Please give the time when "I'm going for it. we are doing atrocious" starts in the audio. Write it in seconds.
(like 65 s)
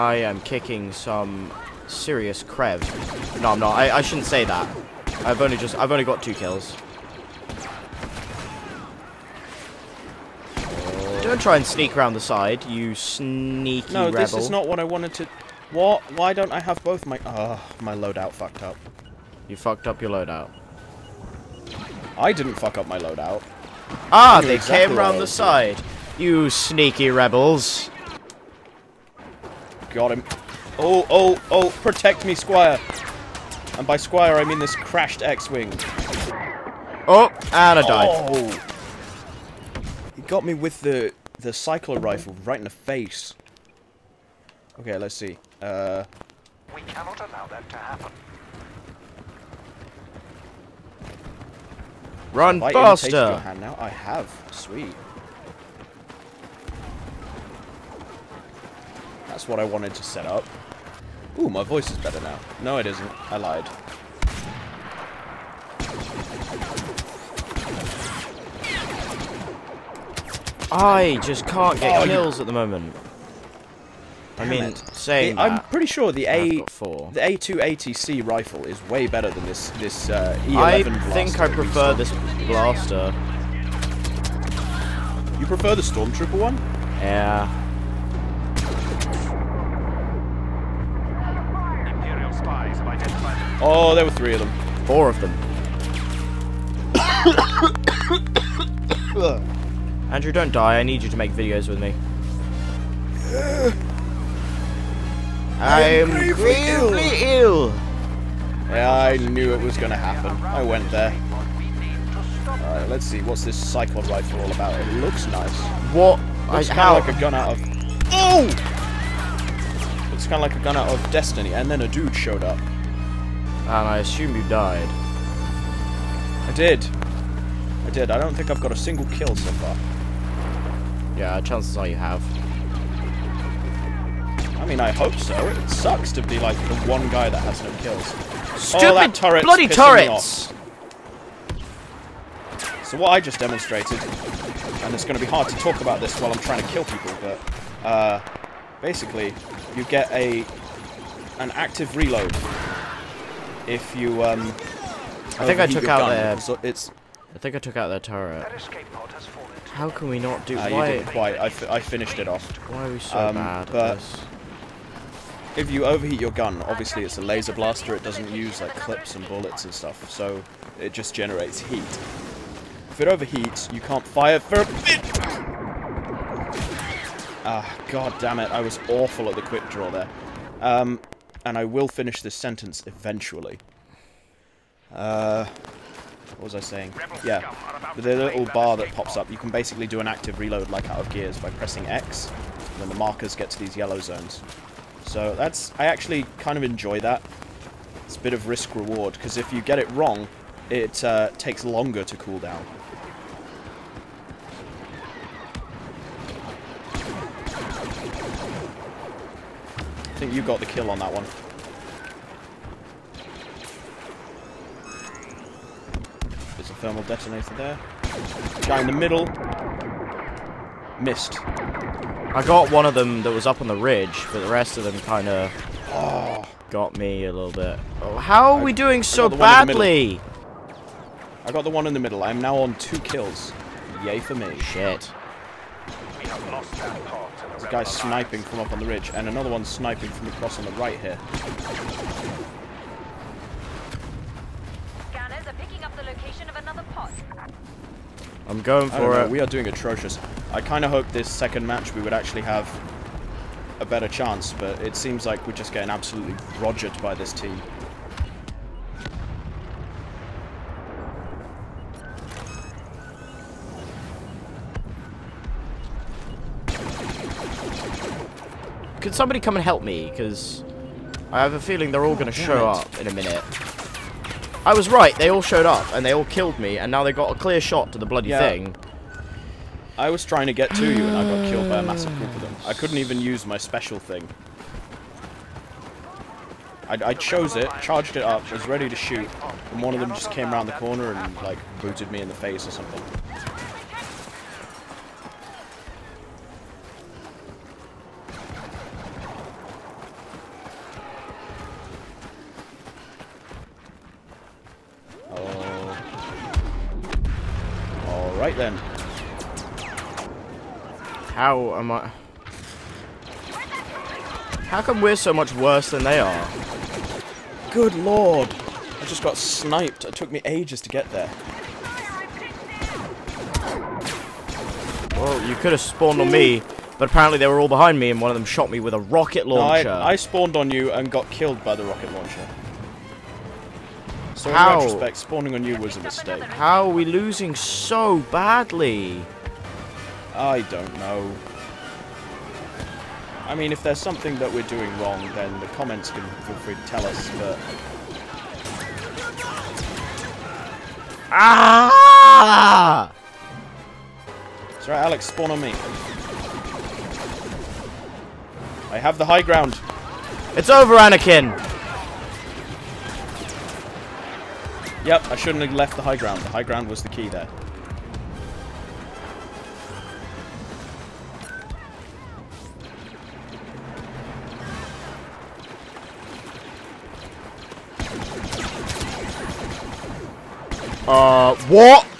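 248 s.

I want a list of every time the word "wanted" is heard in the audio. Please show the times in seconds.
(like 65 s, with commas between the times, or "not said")
14 s, 59 s.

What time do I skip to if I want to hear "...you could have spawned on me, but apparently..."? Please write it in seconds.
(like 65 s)
325 s.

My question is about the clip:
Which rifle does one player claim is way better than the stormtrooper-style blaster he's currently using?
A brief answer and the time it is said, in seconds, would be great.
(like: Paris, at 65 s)
A280C, at 77 s.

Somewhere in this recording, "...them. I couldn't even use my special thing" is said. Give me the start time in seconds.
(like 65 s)
282 s.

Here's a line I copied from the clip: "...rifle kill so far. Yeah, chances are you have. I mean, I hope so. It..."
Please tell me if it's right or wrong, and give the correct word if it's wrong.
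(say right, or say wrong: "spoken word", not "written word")
wrong: "single", not "rifle".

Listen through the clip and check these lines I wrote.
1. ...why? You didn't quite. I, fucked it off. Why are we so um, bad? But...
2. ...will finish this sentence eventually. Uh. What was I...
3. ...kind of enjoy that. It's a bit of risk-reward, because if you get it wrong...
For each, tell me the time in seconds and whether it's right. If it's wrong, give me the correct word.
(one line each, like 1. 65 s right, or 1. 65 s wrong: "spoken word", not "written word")
1. 160 s wrong: "finished", not "fucked"
2. 181 s right
3. 196 s right.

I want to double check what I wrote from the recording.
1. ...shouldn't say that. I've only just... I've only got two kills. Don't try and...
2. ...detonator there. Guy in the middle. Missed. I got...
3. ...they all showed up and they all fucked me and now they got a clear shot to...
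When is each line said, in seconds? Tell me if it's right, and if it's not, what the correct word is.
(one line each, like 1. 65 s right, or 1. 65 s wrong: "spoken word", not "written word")
1. 4 s right
2. 217 s right
3. 275 s wrong: "killed", not "fucked".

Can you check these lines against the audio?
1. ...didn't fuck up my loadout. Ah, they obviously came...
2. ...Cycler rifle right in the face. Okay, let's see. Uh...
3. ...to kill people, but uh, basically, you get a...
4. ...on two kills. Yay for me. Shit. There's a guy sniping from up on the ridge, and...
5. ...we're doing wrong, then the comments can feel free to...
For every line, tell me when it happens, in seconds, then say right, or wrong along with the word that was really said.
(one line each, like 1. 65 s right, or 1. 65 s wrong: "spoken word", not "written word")
1. 22 s wrong: "exactly", not "obviously"
2. 41 s right
3. 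146 s right
4. 232 s right
5. 344 s right.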